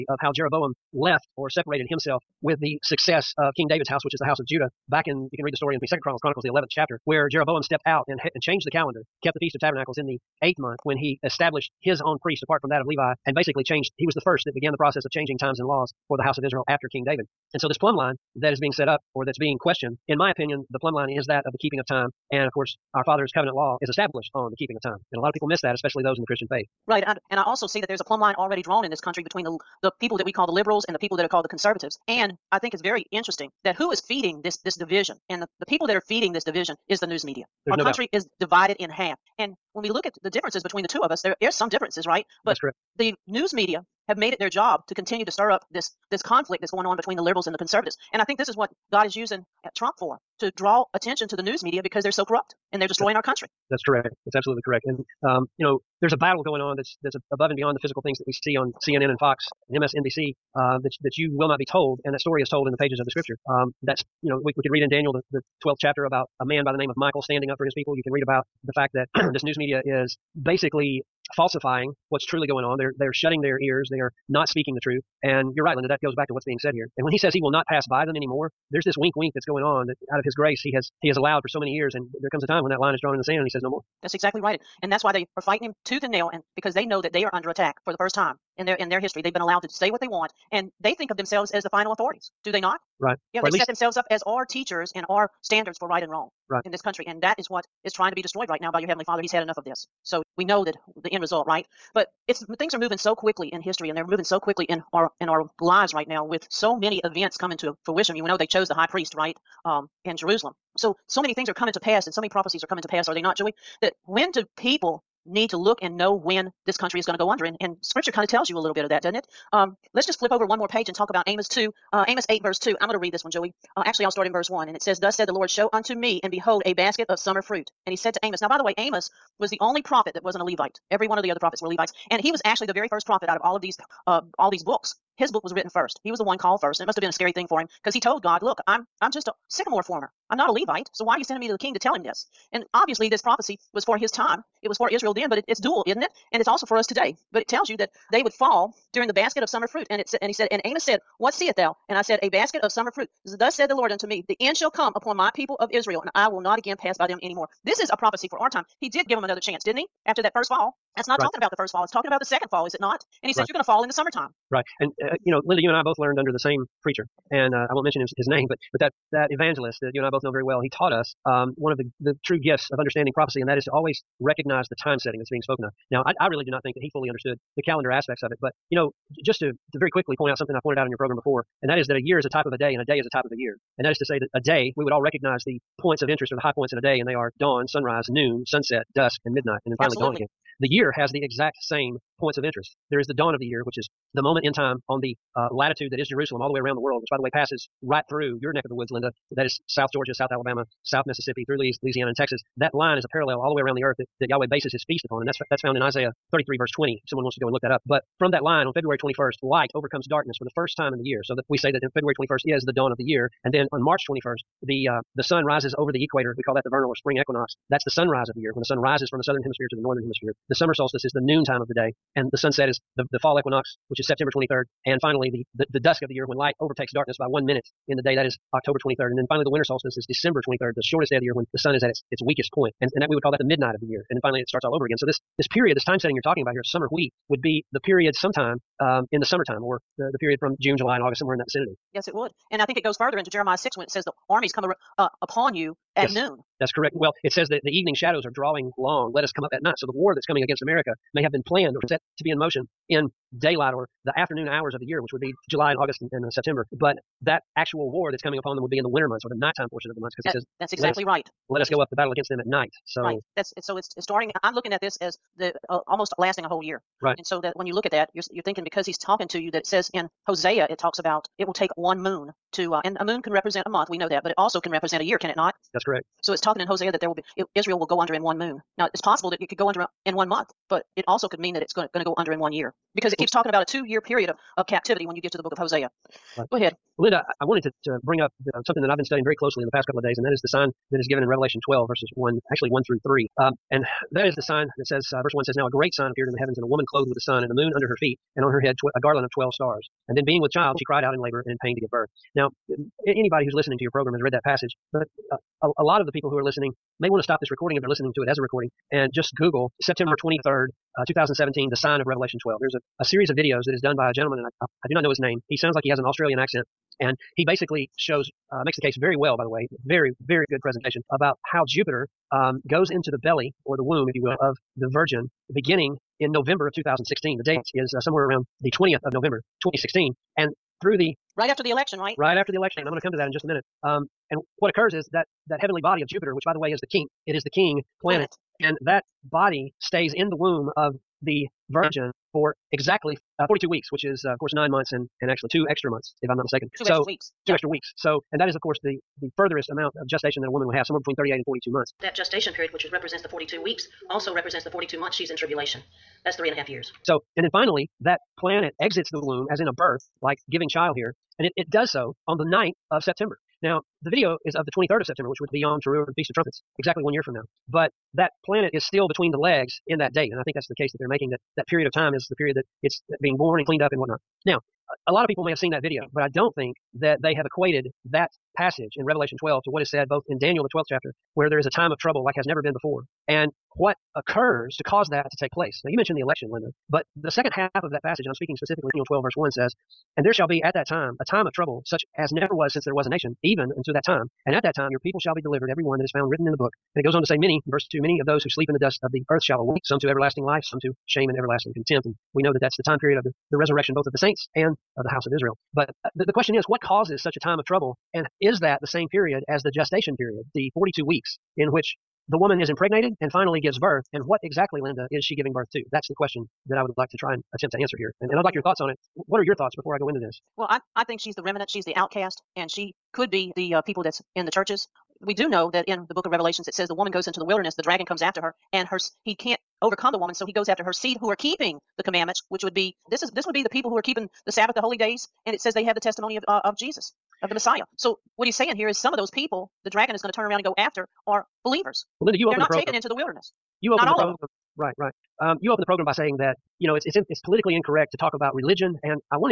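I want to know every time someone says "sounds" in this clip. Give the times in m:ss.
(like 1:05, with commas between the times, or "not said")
5:15.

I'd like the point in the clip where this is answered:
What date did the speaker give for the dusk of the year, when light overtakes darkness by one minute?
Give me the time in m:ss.
3:48.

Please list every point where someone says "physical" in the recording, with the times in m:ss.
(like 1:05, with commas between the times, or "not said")
0:57.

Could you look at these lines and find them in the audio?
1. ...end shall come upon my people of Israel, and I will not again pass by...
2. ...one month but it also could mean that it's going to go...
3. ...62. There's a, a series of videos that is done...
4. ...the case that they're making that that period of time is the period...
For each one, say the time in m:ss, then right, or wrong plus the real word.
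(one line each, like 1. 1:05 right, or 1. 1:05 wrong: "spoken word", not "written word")
1. 2:34 right
2. 4:40 right
3. 5:12 wrong: "12", not "62"
4. 6:10 right.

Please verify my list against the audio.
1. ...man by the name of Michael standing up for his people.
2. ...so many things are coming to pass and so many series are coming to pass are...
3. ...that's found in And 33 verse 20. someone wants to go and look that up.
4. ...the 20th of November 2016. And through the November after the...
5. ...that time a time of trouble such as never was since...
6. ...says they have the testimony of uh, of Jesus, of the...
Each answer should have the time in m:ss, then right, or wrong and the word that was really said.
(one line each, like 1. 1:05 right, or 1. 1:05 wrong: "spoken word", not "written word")
1. 1:06 right
2. 1:51 wrong: "prophecies", not "series"
3. 3:25 wrong: "Isaiah", not "And"
4. 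5:28 wrong: "Right", not "November"
5. 6:30 right
6. 7:15 right.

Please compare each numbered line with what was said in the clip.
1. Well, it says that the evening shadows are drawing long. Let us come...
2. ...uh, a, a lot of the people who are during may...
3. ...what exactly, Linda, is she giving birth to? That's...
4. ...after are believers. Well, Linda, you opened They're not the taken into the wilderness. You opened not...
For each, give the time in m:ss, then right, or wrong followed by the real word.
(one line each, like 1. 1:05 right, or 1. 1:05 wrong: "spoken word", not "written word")
1. 4:06 right
2. 5:05 wrong: "listening", not "during"
3. 6:54 right
4. 7:20 right.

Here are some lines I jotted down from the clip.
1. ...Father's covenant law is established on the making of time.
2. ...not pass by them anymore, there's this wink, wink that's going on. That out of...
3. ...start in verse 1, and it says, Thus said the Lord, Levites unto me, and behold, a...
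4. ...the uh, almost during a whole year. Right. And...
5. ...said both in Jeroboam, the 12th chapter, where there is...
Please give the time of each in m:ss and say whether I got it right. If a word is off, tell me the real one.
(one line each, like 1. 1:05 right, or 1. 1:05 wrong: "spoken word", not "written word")
1. 0:23 wrong: "keeping", not "making"
2. 1:17 right
3. 2:04 wrong: "Show", not "Levites"
4. 4:25 wrong: "lasting", not "during"
5. 6:19 wrong: "Daniel", not "Jeroboam".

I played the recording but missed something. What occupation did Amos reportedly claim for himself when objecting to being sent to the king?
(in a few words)
sycamore farmer.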